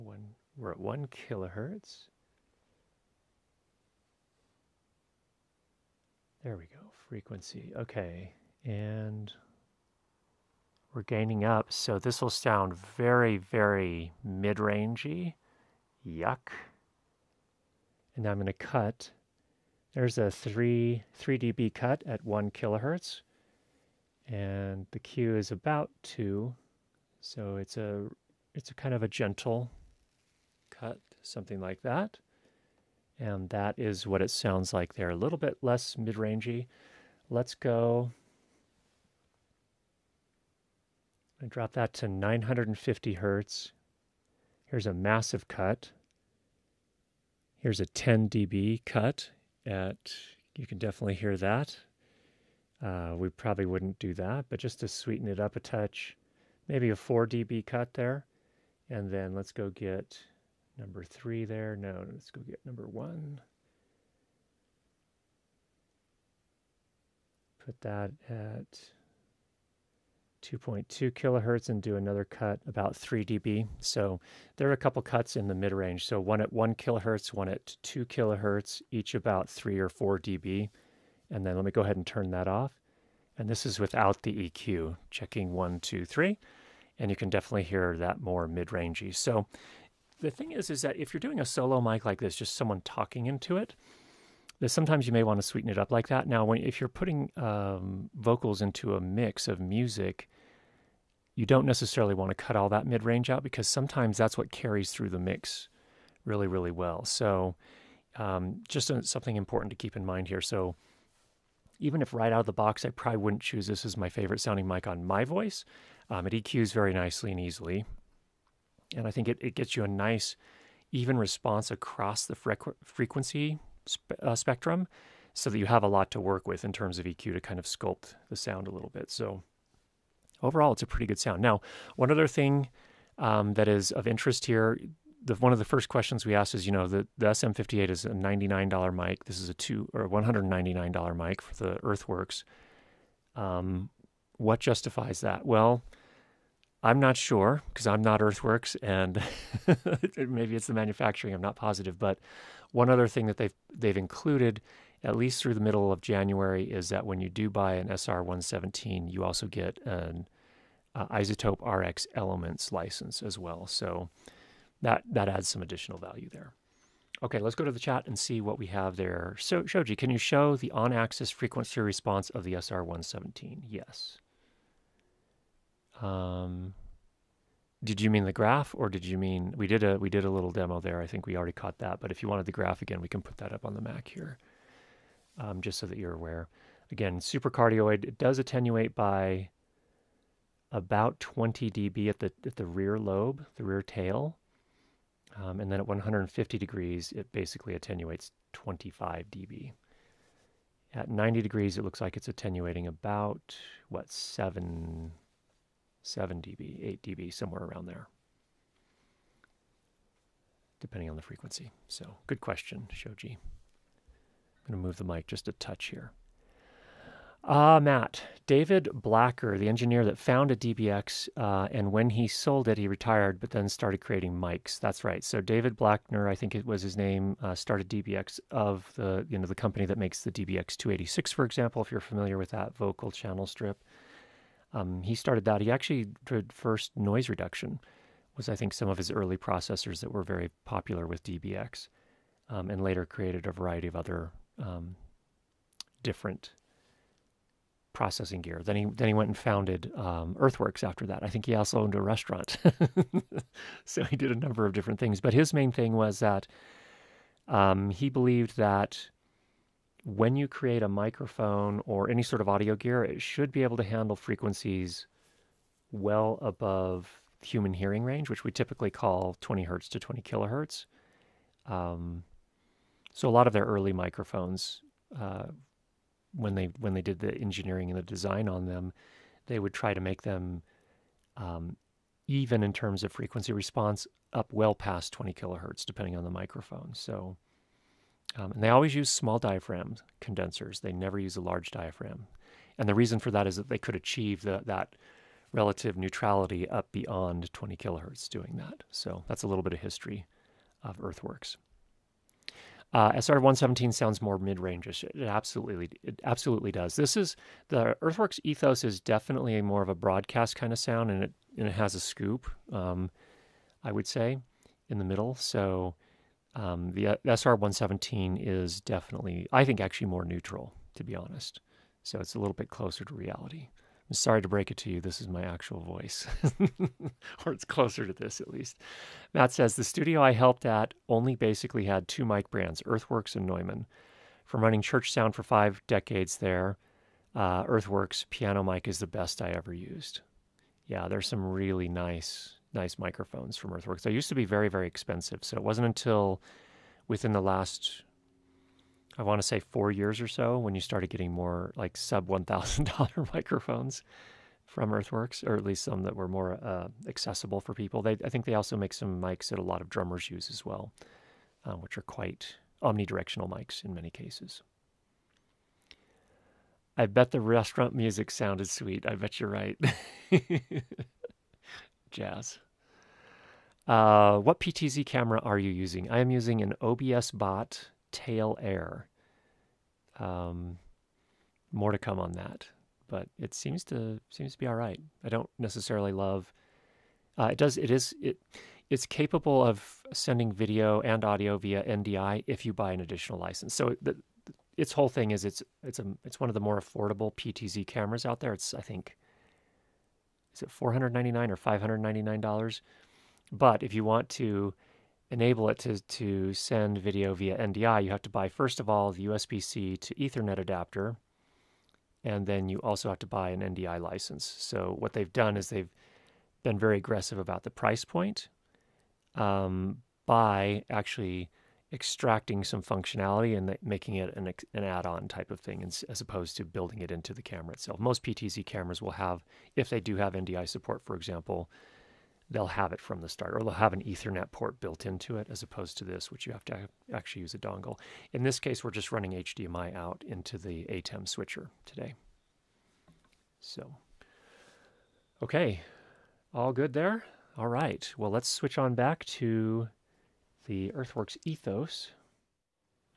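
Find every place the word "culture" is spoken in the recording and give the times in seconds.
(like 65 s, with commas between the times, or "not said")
not said.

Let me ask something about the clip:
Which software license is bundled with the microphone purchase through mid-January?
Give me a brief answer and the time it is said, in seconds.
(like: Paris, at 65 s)
iZotope RX Elements, at 161 s.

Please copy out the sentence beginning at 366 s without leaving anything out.
I bet the restaurant music sounded sweet.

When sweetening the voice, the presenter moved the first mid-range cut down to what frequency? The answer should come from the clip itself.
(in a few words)
950 Hz.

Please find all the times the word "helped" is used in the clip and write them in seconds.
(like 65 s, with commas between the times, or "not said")
330 s.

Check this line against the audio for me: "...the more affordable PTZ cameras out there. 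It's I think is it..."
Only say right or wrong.
right.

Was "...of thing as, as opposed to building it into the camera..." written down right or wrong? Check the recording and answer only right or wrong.
right.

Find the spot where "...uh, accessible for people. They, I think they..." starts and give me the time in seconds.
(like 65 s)
356 s.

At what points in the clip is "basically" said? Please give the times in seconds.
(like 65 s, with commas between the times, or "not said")
197 s, 331 s.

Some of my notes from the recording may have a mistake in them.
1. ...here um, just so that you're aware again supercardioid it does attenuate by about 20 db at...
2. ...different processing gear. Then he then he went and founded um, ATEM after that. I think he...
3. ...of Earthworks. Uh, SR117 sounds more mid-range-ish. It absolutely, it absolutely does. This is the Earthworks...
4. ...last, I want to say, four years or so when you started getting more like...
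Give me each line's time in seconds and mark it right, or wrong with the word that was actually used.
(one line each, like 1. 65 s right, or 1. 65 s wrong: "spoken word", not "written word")
1. 184 s right
2. 246 s wrong: "Earthworks", not "ATEM"
3. 300 s right
4. 347 s right.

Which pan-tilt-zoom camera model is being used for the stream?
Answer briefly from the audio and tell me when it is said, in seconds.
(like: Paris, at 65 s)
OBSBOT Tail Air, at 376 s.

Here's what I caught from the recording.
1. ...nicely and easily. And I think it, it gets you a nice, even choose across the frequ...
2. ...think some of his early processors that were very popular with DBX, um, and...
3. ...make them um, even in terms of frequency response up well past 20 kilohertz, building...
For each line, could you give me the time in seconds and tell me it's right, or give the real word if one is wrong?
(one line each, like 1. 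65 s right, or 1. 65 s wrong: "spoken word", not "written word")
1. 116 s wrong: "response", not "choose"
2. 238 s right
3. 280 s wrong: "depending", not "building".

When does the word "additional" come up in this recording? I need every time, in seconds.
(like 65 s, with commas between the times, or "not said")
165 s, 393 s.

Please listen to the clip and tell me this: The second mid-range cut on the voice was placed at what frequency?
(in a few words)
2.2 kHz.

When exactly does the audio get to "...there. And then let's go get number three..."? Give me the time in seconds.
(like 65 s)
57 s.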